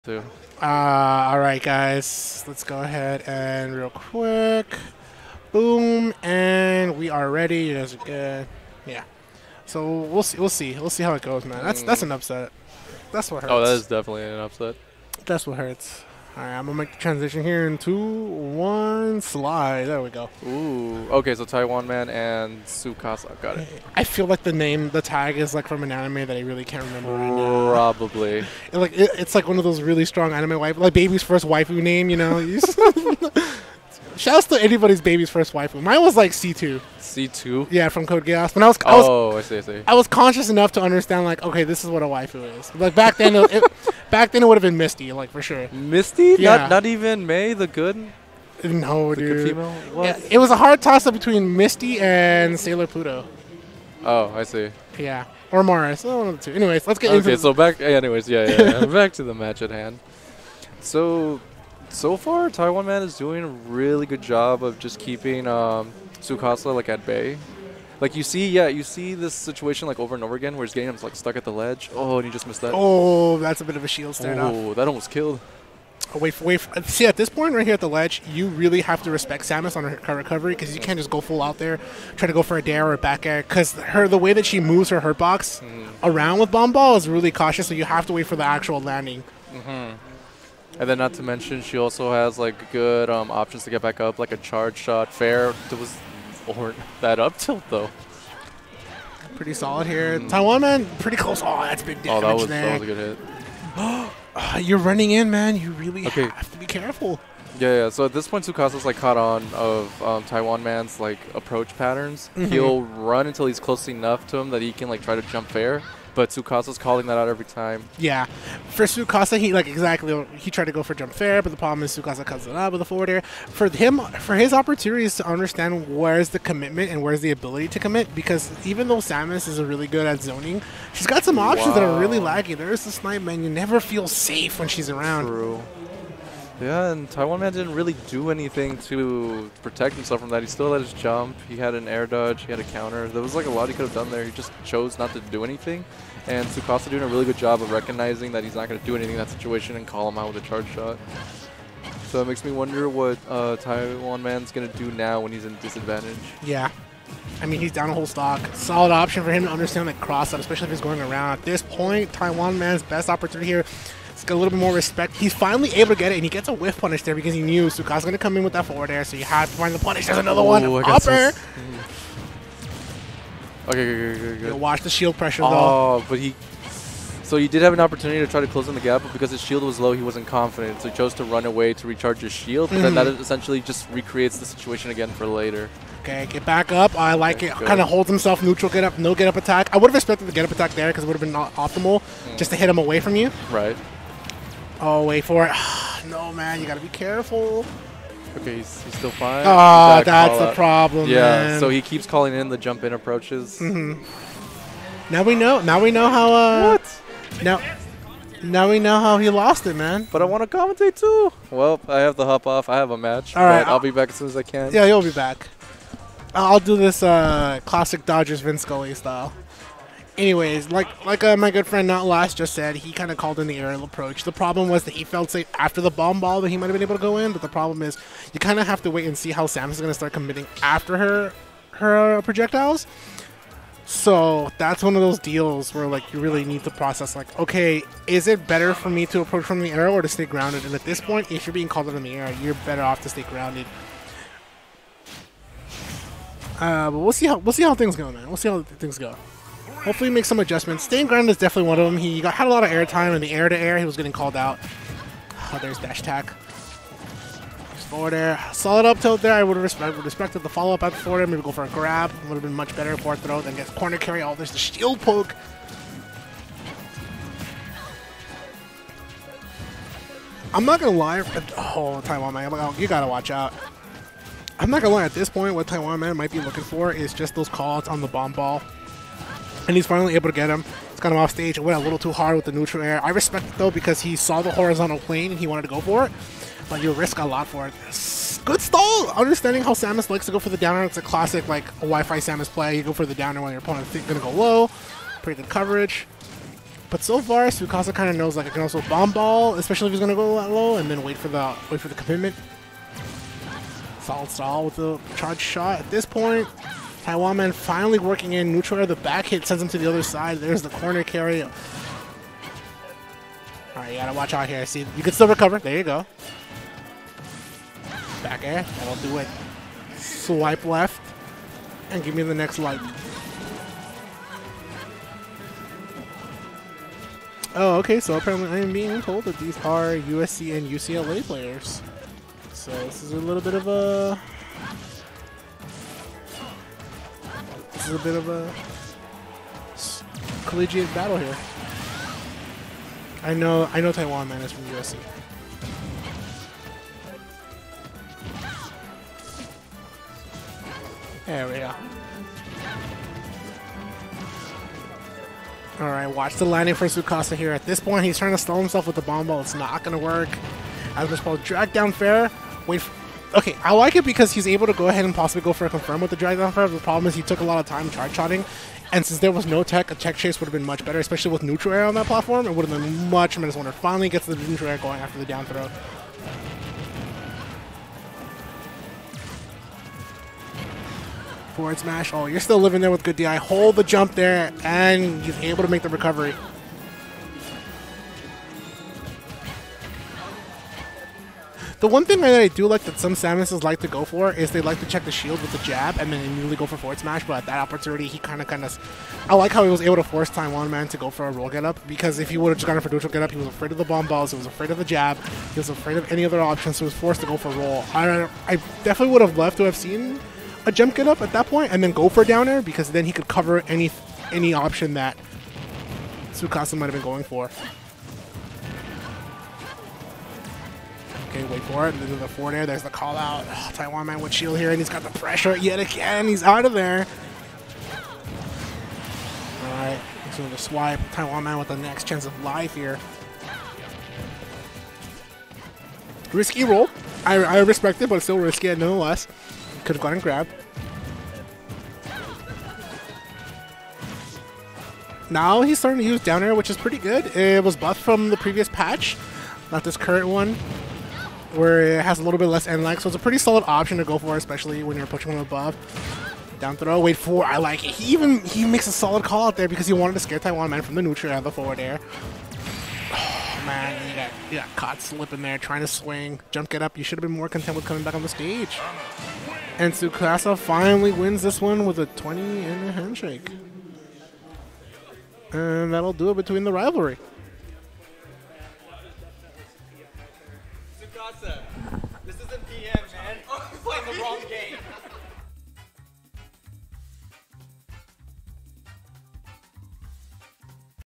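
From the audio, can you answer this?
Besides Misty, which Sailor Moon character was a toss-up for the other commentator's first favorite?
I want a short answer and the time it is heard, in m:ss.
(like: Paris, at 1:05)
Sailor Pluto, at 0:52.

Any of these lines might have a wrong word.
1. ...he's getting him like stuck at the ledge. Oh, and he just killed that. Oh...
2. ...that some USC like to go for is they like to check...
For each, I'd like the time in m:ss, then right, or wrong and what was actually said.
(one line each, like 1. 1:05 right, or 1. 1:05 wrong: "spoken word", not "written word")
1. 1:10 wrong: "missed", not "killed"
2. 6:32 wrong: "Samuses", not "USC".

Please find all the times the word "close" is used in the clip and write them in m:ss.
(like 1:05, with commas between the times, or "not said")
1:41, 1:53, 2:58.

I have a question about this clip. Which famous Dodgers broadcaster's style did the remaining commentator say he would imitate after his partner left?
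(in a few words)
Vince Scully.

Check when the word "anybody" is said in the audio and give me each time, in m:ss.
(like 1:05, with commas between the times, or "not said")
0:34.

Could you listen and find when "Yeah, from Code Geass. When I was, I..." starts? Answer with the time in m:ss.
0:37.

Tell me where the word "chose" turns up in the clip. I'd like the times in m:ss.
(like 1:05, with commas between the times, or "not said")
2:24, 3:00.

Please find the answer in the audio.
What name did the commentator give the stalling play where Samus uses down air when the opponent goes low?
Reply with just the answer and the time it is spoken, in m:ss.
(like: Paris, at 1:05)
Wi-Fi Samus play, at 4:51.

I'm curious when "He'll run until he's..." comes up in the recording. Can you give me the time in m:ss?
1:52.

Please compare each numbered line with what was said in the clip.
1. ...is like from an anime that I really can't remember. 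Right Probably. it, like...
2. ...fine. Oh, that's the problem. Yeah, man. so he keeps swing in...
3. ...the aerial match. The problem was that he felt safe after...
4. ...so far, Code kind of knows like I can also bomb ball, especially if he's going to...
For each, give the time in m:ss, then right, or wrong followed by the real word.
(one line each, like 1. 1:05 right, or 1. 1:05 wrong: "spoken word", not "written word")
1. 0:25 right
2. 3:19 wrong: "calling", not "swing"
3. 3:43 wrong: "approach", not "match"
4. 4:57 wrong: "Txukasa", not "Code".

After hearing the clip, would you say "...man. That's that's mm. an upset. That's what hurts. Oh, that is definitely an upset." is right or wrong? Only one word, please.
right.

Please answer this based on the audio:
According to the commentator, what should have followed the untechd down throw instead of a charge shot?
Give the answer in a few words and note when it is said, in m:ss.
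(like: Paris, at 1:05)
a tech chase, at 6:09.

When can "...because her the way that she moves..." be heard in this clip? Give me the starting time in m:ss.
1:23.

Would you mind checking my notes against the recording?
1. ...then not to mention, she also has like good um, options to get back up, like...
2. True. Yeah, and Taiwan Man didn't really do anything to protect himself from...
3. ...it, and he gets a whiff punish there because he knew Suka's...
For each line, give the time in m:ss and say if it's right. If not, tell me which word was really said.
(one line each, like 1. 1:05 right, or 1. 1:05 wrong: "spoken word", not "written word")
1. 1:30 right
2. 2:15 right
3. 2:46 right.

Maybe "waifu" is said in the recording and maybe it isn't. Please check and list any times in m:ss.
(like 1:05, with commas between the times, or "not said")
0:31, 0:35, 0:42.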